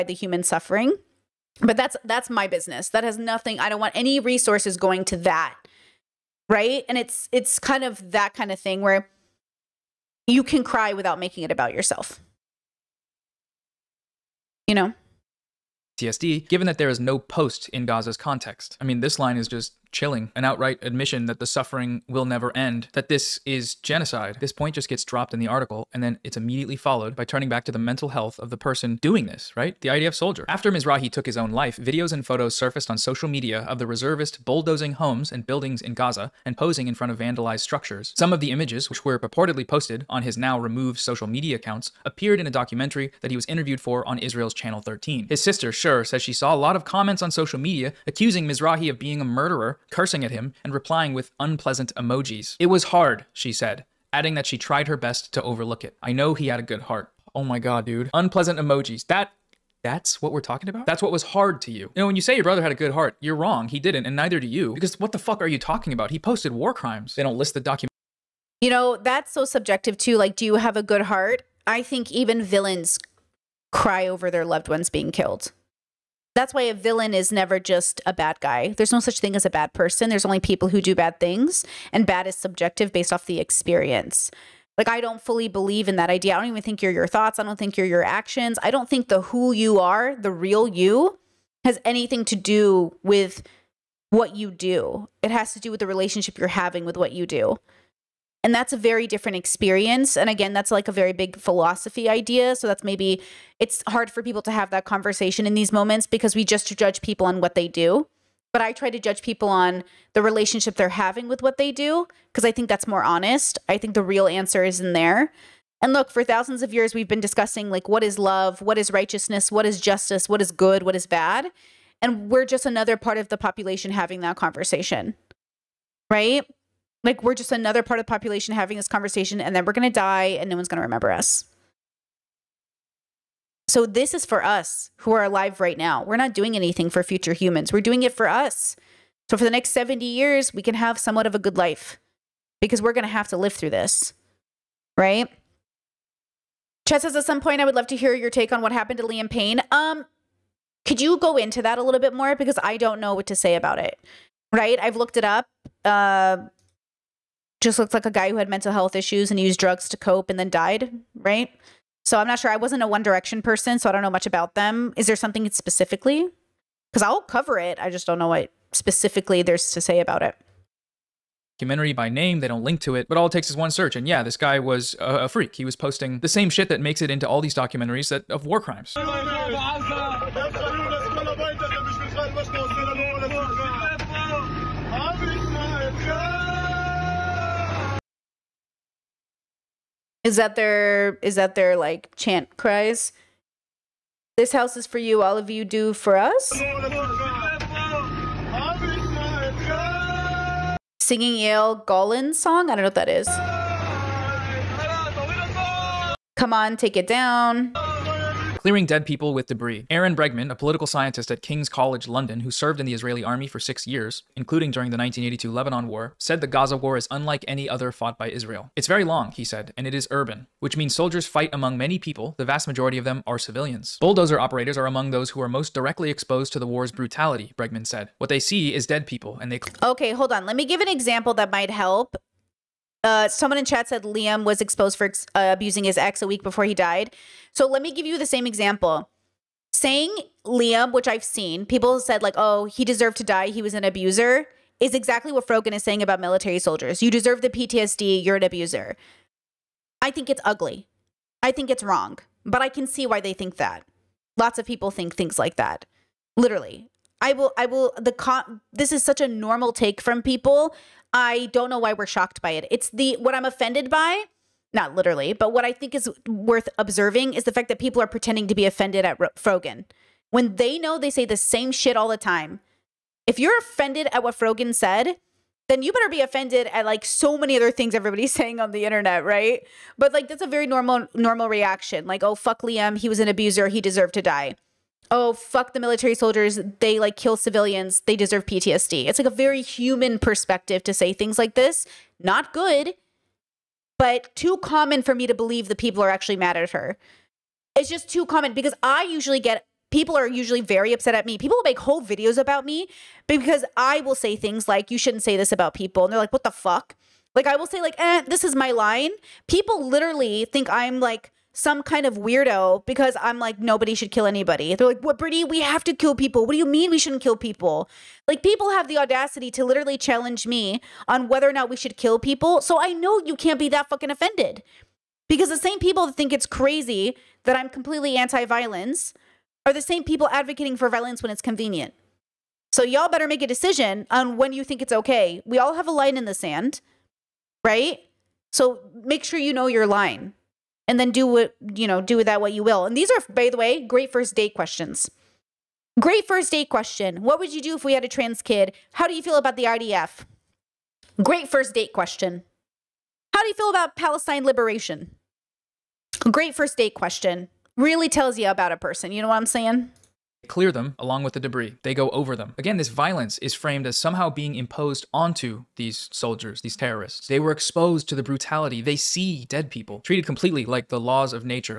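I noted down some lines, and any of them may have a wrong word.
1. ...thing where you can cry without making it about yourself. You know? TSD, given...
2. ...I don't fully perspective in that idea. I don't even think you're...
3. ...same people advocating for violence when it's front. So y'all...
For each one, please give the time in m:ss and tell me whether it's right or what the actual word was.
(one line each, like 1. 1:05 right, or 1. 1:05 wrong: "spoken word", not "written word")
1. 0:08 right
2. 1:24 wrong: "believe", not "perspective"
3. 5:29 wrong: "convenient", not "front".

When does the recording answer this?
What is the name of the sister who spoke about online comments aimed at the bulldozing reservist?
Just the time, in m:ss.
0:45.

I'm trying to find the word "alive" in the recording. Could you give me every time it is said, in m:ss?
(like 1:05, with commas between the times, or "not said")
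2:15.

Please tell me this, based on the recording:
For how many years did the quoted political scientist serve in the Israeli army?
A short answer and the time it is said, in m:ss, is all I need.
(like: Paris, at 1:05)
6, at 3:33.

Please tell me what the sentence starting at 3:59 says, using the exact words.
Saying Liam, which I've seen, people said like, "Oh, he deserved to die.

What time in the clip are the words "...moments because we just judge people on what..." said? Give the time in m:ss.
1:45.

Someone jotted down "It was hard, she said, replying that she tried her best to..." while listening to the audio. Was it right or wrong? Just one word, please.
wrong.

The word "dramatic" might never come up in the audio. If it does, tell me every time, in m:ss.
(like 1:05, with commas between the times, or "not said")
not said.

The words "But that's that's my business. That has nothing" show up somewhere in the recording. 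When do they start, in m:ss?
0:01.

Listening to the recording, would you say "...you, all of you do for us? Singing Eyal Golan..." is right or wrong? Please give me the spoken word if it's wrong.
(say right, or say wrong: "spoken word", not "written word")
right.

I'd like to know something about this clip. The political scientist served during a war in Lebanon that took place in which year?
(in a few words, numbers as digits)
1982.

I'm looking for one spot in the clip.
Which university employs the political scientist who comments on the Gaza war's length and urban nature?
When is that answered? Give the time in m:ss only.
3:31.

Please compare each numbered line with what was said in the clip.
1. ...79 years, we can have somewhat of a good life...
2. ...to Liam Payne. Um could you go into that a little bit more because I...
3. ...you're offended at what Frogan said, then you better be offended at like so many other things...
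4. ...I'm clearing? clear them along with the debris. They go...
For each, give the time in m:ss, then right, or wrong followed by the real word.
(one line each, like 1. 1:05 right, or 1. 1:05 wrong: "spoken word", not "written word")
1. 2:19 wrong: "70", not "79"
2. 2:28 right
3. 4:33 right
4. 5:59 wrong: "saying", not "clearing".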